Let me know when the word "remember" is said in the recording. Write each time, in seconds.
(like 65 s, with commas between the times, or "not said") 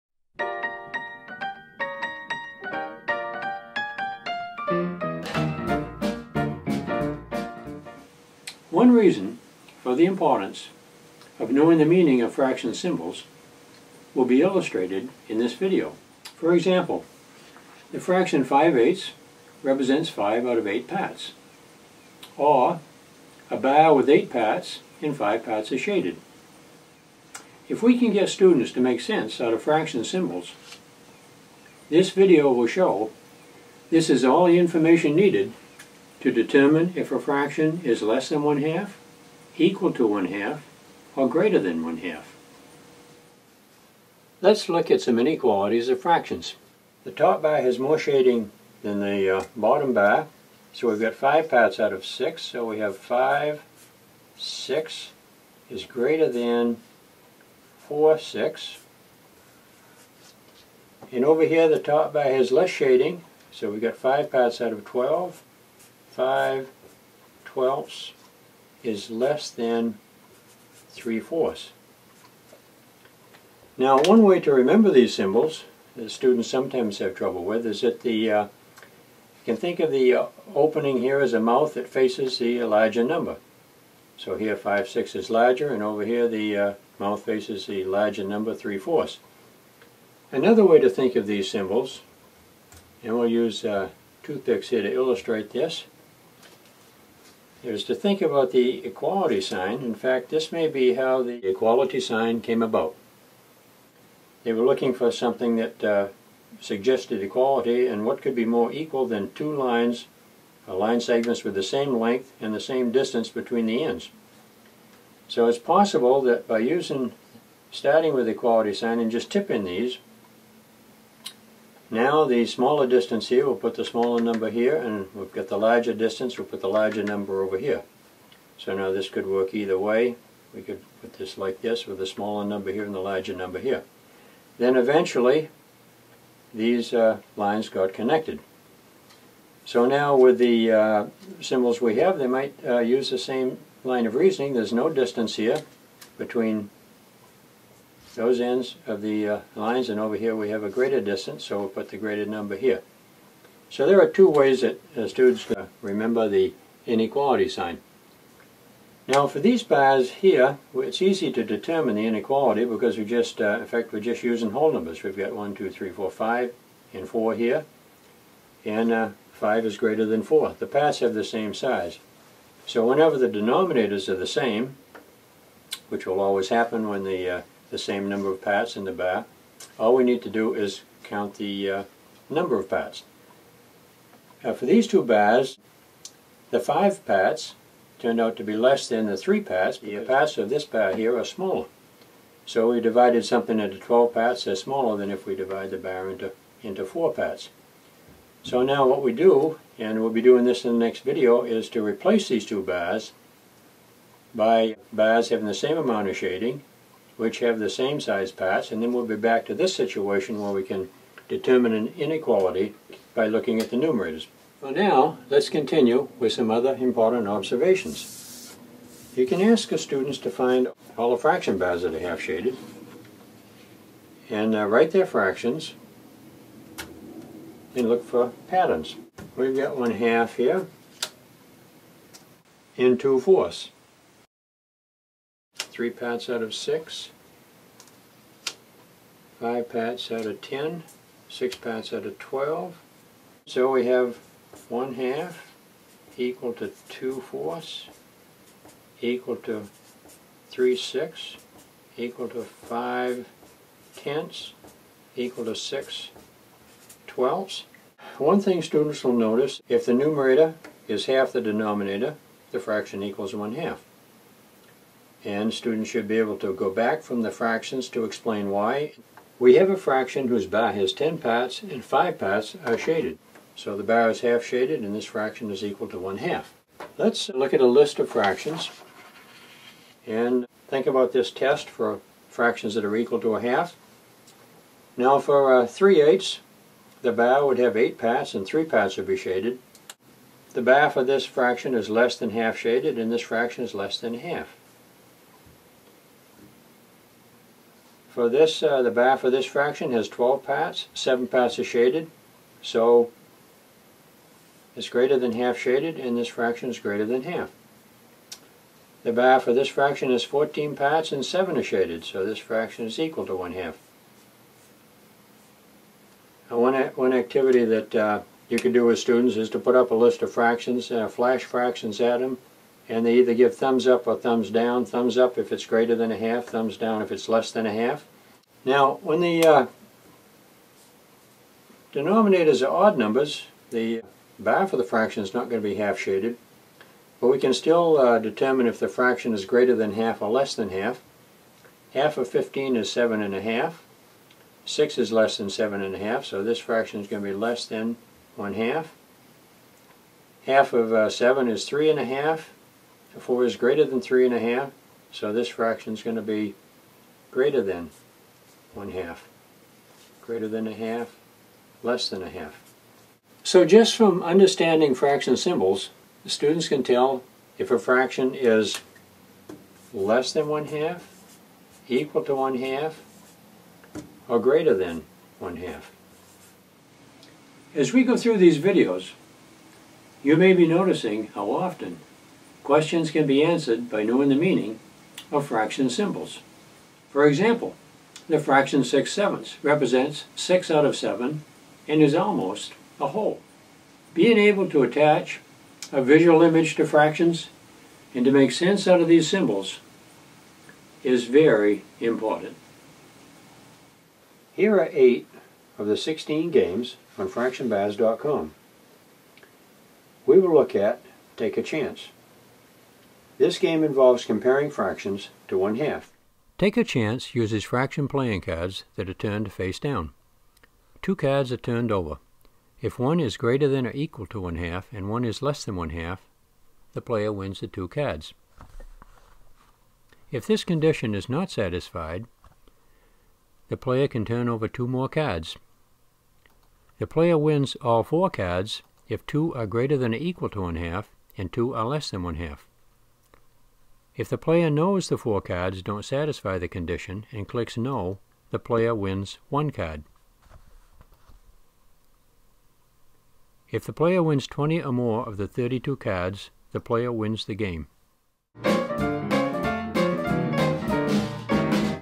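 74 s, 155 s.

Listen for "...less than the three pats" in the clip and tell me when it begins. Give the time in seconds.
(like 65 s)
188 s.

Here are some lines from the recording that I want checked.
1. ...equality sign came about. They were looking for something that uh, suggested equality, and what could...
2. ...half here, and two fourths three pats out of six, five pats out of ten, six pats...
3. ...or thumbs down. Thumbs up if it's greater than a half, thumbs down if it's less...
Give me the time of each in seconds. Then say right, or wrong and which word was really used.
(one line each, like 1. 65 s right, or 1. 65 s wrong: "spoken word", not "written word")
1. 101 s right
2. 229 s right
3. 324 s right.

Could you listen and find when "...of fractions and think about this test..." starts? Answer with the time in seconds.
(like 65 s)
277 s.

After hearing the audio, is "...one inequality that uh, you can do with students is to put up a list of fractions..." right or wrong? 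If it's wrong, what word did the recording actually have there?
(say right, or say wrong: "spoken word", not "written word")
wrong: "activity", not "inequality".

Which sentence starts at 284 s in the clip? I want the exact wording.
Now for uh, 3 eighths, the bar would have 8 parts and 3 parts would be shaded.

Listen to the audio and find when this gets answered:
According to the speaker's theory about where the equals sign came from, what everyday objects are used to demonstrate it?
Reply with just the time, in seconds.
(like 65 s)
94 s.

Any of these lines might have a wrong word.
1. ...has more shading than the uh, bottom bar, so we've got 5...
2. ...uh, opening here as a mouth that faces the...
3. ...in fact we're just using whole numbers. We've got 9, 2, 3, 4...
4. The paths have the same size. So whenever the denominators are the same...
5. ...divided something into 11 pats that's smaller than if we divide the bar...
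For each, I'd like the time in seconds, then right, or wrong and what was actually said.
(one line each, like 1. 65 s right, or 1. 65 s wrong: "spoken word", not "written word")
1. 47 s right
2. 80 s right
3. 163 s wrong: "1", not "9"
4. 170 s right
5. 192 s wrong: "12", not "11".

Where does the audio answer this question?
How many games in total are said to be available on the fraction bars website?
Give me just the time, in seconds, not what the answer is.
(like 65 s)
405 s.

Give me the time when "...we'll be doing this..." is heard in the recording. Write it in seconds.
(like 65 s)
200 s.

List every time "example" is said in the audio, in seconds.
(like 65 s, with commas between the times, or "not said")
16 s, 387 s.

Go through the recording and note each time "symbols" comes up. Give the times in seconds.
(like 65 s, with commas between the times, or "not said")
12 s, 30 s, 75 s, 91 s, 141 s, 365 s, 385 s, 399 s.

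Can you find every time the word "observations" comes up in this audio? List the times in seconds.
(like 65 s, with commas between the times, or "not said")
217 s.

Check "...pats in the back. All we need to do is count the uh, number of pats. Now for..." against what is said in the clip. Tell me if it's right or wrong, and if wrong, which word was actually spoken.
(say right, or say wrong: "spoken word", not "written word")
right.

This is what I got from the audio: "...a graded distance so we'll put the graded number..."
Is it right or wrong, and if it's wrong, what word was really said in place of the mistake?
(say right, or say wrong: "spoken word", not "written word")
right.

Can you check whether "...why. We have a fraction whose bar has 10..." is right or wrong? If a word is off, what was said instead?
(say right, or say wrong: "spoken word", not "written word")
right.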